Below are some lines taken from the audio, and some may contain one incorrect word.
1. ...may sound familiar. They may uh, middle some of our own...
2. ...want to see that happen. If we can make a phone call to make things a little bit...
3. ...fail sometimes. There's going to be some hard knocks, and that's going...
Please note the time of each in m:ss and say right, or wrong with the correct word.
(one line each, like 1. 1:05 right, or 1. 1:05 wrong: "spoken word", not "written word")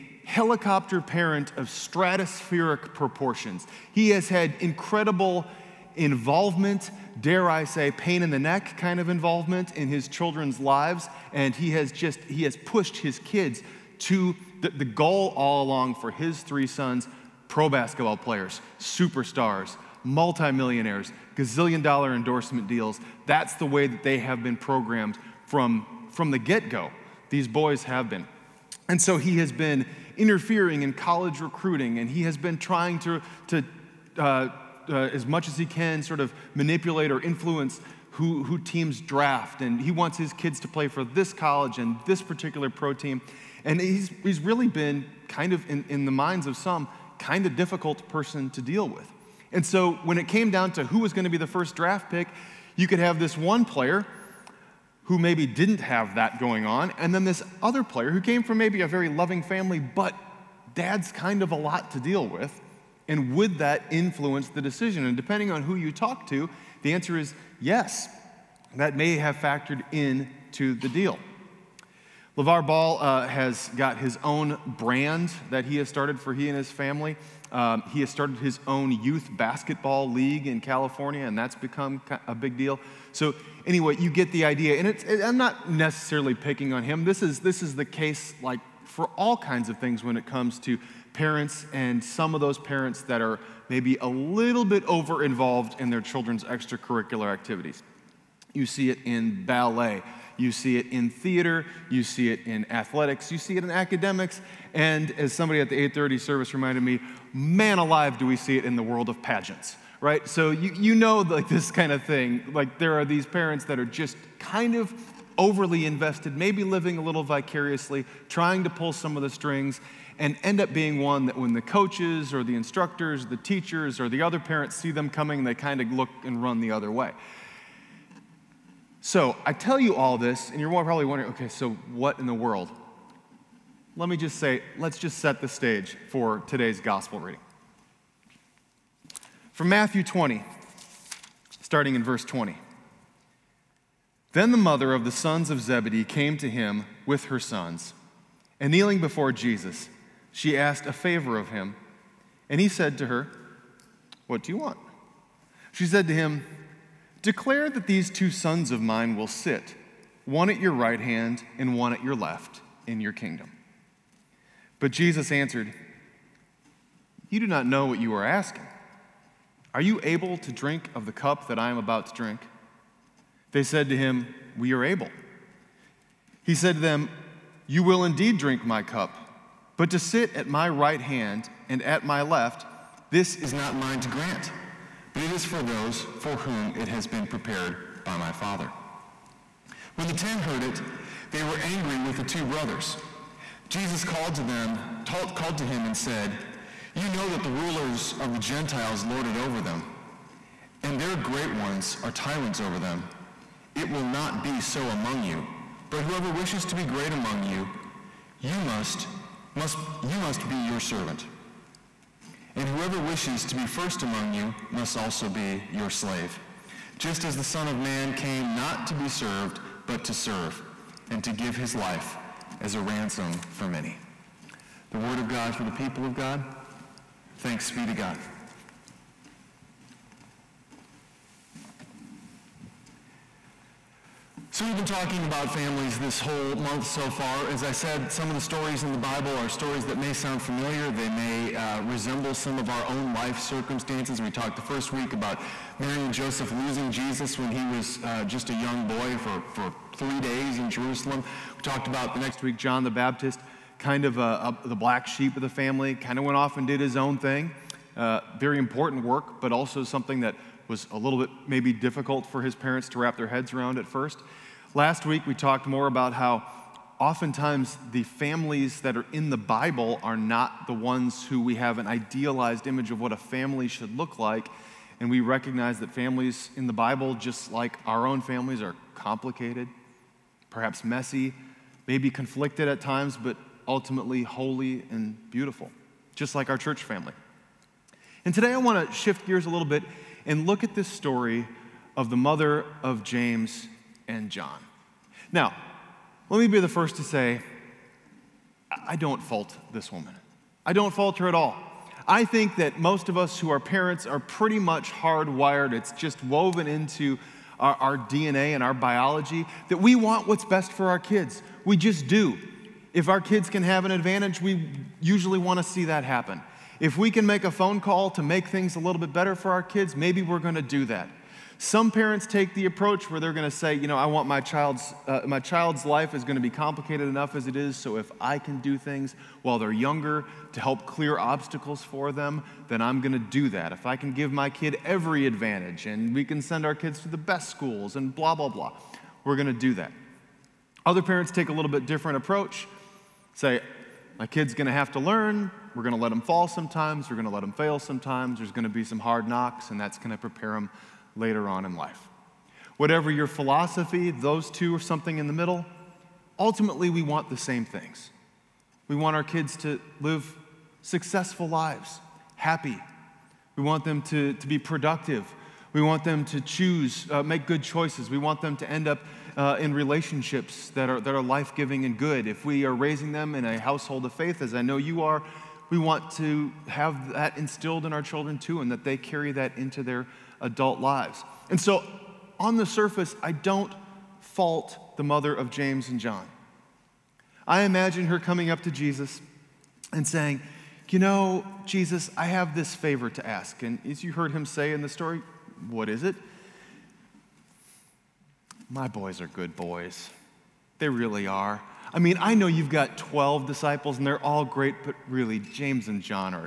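1. 3:59 wrong: "resemble", not "middle"
2. 5:15 right
3. 5:47 right.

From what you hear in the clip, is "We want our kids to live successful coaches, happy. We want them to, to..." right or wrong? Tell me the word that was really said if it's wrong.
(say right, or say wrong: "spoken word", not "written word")
wrong: "lives", not "coaches".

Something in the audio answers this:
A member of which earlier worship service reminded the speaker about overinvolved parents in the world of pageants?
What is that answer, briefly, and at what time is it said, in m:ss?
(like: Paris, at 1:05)
8:30 service, at 1:45.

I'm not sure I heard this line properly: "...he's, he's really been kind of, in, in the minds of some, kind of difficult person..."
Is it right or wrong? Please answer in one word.
right.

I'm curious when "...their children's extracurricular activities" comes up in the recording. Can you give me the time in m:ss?
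1:35.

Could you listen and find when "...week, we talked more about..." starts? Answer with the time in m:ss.
4:25.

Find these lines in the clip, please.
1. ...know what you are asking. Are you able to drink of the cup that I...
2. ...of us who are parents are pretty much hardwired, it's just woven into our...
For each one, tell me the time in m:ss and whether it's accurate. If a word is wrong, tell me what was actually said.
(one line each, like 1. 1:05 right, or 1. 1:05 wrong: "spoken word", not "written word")
1. 2:47 right
2. 5:03 right.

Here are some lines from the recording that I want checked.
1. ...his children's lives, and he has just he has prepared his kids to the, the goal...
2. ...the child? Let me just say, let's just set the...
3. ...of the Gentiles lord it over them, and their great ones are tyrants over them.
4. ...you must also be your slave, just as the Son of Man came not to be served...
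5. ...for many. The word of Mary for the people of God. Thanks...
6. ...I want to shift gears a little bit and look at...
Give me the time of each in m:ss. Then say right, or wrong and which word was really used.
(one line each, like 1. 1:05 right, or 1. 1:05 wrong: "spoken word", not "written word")
1. 0:09 wrong: "pushed", not "prepared"
2. 2:12 wrong: "world", not "child"
3. 3:18 right
4. 3:34 right
5. 3:43 wrong: "God", not "Mary"
6. 4:48 right.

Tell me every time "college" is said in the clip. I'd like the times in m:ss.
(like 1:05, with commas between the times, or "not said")
0:30, 0:41.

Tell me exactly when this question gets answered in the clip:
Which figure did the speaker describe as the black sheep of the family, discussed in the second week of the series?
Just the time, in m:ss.
4:12.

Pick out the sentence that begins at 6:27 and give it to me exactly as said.
I imagine her coming up to Jesus and saying, You know, Jesus, I have this favor to ask.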